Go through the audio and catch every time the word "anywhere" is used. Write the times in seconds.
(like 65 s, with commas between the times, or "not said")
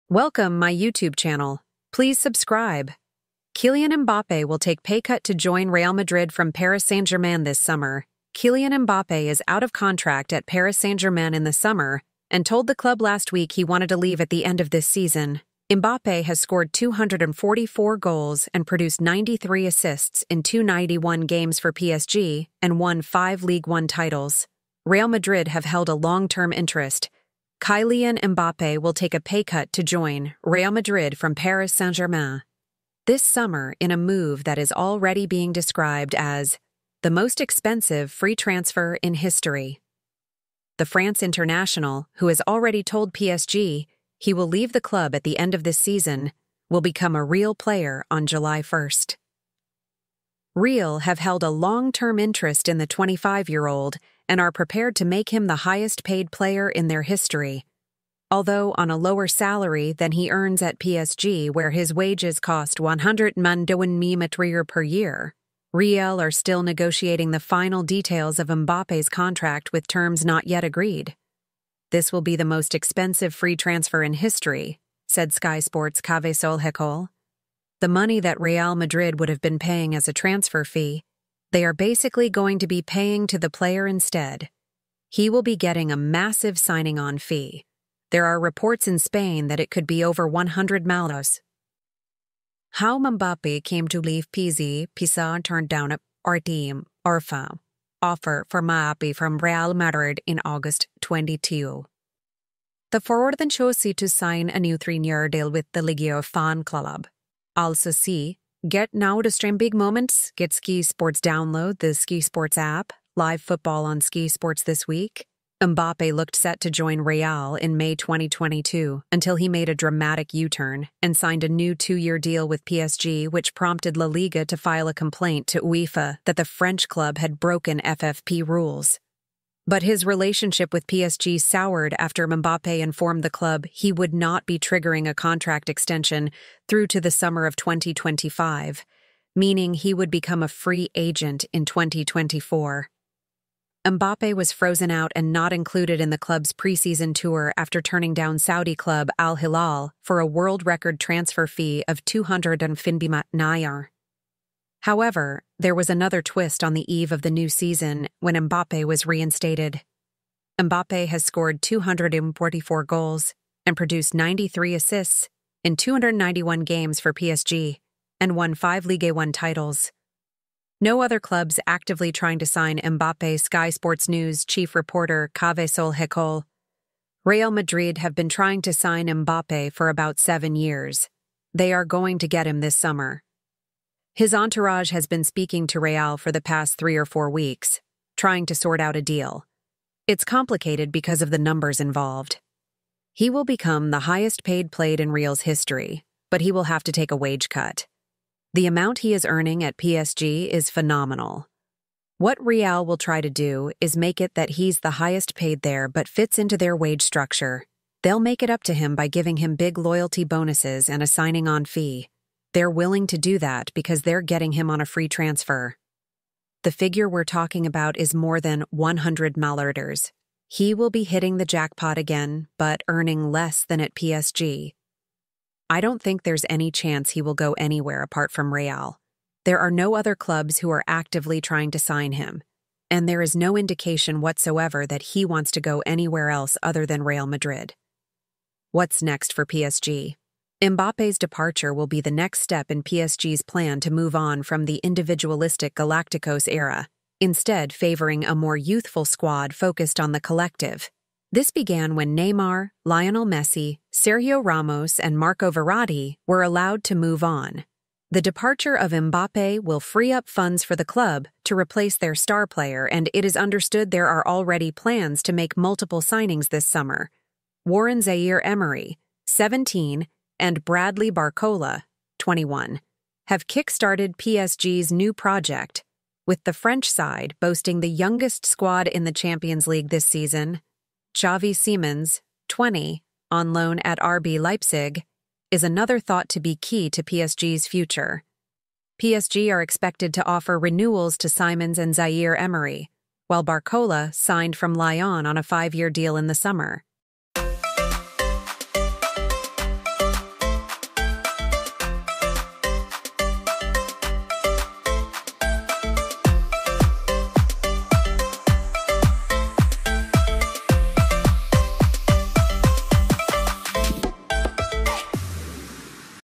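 227 s, 235 s.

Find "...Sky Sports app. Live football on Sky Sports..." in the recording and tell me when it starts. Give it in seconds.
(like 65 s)
111 s.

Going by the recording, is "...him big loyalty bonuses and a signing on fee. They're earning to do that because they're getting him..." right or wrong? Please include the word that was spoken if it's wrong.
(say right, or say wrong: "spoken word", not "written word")
wrong: "willing", not "earning".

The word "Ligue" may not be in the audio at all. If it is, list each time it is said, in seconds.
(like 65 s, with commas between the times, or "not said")
23 s, 168 s.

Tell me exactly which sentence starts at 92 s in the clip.
How Mbappe came to leave PZ, Pisa turned down a our Arfa Orfa, offer for Mbappé from Real Madrid in August 22.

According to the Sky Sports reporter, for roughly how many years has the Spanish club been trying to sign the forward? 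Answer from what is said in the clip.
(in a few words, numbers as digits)
7 years.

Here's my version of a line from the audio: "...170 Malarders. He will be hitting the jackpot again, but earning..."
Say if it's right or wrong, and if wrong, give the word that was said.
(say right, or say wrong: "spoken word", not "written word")
wrong: "100", not "170".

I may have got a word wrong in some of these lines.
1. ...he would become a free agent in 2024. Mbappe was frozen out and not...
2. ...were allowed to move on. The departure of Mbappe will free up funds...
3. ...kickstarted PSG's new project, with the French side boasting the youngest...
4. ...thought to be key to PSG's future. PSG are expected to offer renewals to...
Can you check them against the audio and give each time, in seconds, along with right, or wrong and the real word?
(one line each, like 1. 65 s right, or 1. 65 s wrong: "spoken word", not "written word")
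1. 139 s right
2. 256 s right
3. 273 s right
4. 285 s right.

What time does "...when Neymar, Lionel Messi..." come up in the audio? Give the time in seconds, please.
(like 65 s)
251 s.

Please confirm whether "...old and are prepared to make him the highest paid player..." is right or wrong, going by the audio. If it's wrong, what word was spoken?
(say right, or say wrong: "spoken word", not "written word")
right.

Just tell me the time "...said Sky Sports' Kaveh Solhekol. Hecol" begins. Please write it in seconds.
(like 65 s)
75 s.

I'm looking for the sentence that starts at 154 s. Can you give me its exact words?
However, there was another twist on the eve of the new season when Mbappe was reinstated.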